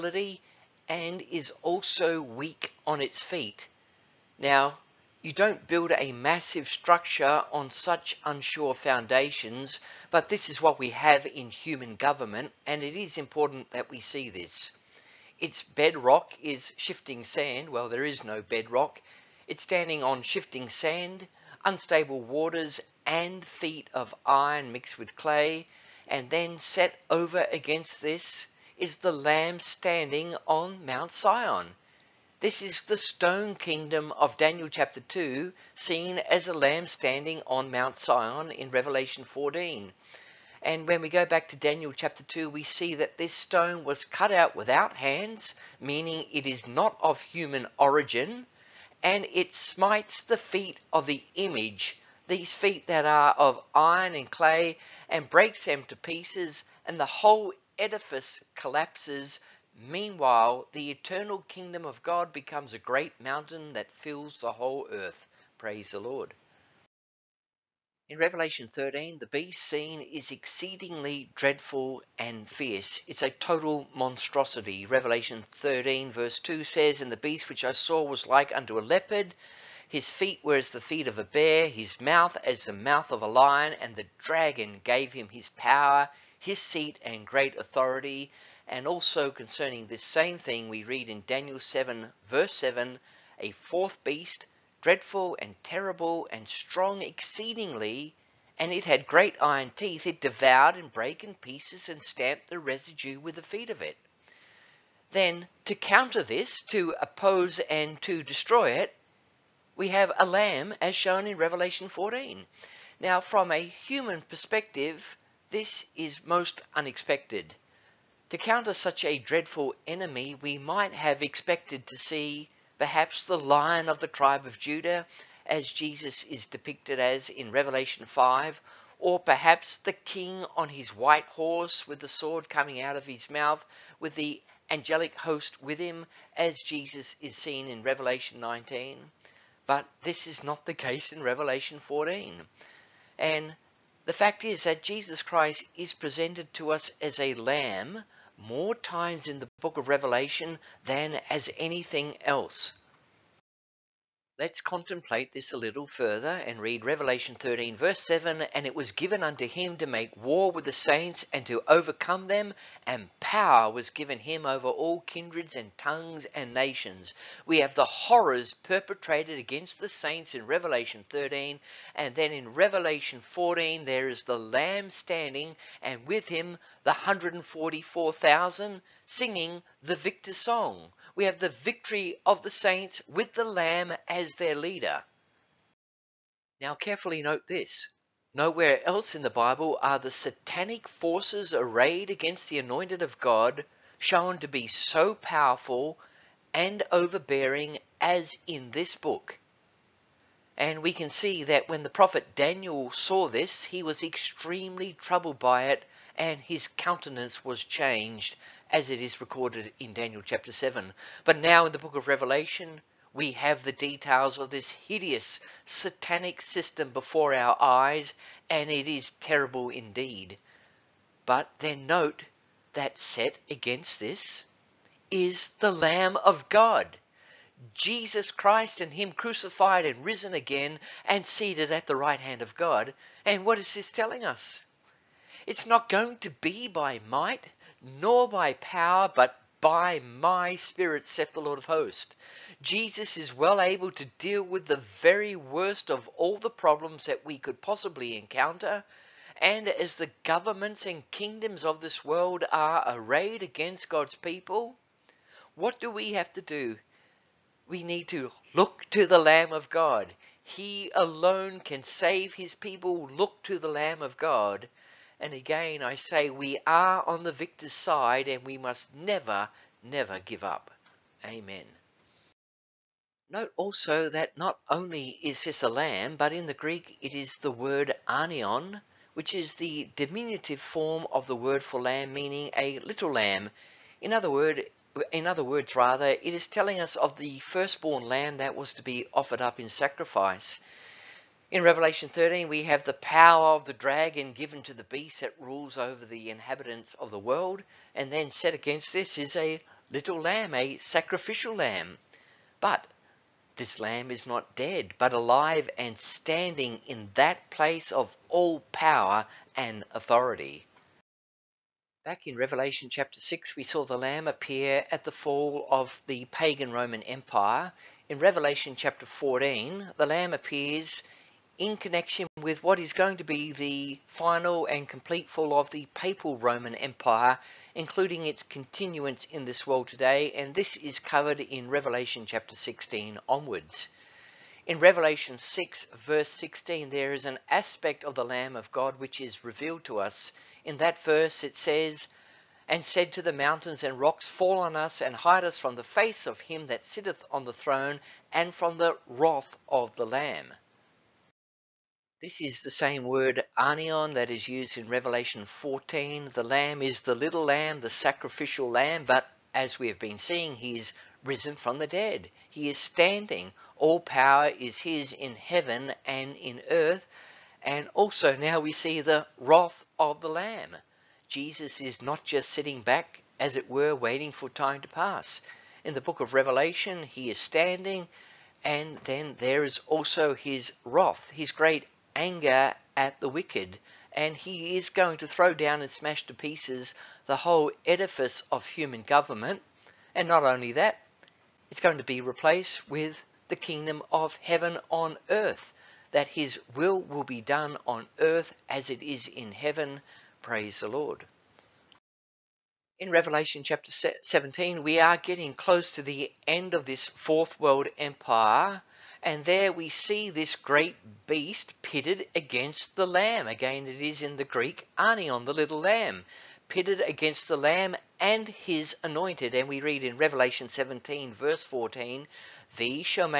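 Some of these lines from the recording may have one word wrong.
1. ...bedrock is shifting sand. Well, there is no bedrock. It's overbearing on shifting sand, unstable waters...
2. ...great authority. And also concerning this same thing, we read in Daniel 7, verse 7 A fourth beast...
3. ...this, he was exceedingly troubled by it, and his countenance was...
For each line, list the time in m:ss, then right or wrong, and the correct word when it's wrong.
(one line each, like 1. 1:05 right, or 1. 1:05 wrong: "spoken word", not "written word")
1. 0:15 wrong: "standing", not "overbearing"
2. 1:27 right
3. 3:23 wrong: "extremely", not "exceedingly".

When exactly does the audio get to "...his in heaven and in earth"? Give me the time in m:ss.
6:04.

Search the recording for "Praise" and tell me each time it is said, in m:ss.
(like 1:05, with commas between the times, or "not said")
1:05, 6:40.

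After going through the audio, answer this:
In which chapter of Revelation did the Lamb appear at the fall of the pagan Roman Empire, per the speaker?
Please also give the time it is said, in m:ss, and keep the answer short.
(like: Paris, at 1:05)
Chapter 6, at 5:12.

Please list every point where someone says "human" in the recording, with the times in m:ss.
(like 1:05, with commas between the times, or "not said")
0:11, 0:47, 1:53, 6:28.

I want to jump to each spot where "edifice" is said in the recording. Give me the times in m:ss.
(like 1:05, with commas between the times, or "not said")
0:57, 6:27.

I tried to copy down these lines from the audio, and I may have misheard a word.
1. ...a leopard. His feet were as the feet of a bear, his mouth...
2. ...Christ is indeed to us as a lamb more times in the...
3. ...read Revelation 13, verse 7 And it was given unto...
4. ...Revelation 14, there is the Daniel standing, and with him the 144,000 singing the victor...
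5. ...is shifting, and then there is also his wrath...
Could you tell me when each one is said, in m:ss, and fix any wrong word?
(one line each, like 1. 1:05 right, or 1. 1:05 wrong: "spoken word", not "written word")
1. 1:18 right
2. 2:25 wrong: "presented", not "indeed"
3. 2:36 right
4. 2:52 wrong: "Lamb", not "Daniel"
5. 6:17 wrong: "standing", not "shifting".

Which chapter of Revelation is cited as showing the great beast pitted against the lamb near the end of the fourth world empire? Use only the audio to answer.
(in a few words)
Revelation 17.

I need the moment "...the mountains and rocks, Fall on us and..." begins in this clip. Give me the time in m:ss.
5:43.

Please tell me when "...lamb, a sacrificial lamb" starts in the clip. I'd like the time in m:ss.
5:00.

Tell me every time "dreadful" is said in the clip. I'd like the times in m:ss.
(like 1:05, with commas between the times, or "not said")
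1:11, 1:34, 1:59.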